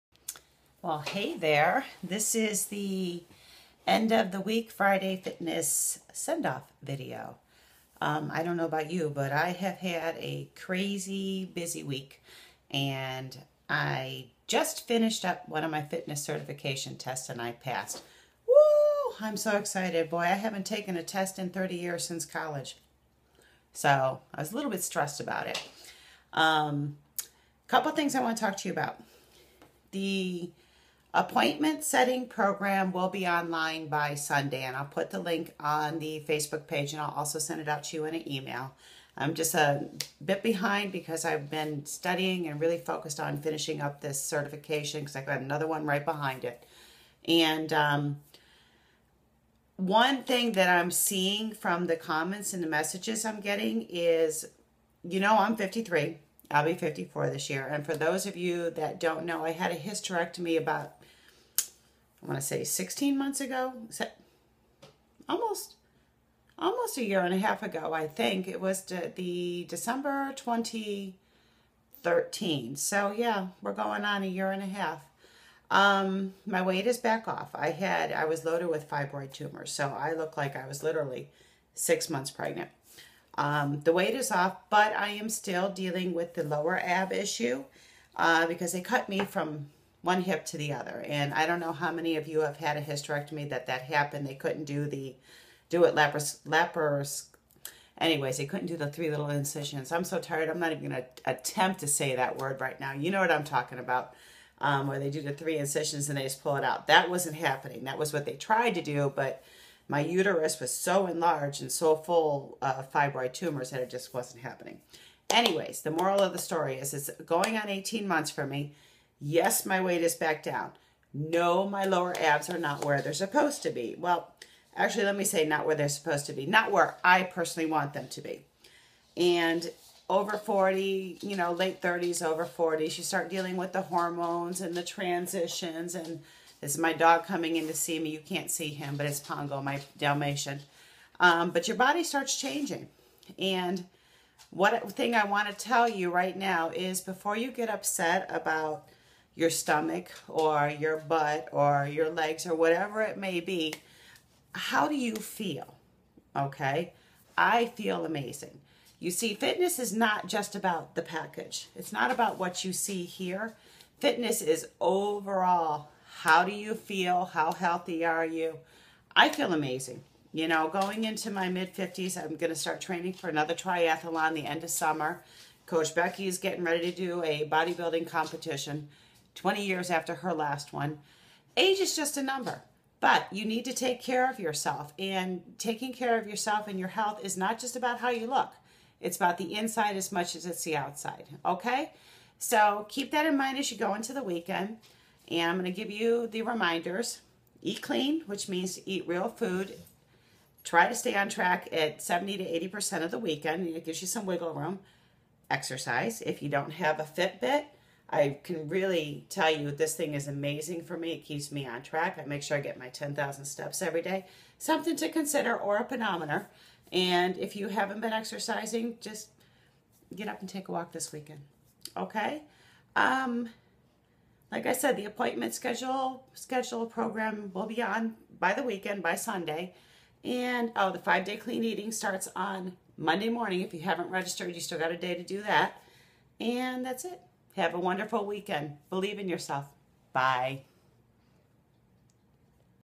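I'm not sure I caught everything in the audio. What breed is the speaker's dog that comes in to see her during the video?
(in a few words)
Dalmatian.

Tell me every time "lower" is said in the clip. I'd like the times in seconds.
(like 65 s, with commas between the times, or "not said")
86 s, 121 s.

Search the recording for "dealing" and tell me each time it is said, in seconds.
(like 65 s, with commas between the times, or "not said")
85 s, 133 s.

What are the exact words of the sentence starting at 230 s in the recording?
And oh, the five day clean eating starts on Monday morning.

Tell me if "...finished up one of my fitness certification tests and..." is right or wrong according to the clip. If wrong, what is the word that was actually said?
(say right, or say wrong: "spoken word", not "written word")
right.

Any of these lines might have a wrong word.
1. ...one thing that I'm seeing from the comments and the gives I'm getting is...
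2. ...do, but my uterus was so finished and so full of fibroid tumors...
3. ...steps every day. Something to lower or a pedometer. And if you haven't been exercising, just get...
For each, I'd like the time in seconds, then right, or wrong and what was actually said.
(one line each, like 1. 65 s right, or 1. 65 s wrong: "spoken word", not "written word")
1. 49 s wrong: "messages", not "gives"
2. 108 s wrong: "enlarged", not "finished"
3. 213 s wrong: "consider", not "lower".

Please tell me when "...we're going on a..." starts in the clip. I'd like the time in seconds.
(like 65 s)
73 s.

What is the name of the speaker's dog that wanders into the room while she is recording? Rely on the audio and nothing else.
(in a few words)
Pongo.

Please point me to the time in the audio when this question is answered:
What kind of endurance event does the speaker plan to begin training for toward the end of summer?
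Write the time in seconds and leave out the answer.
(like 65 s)
173 s.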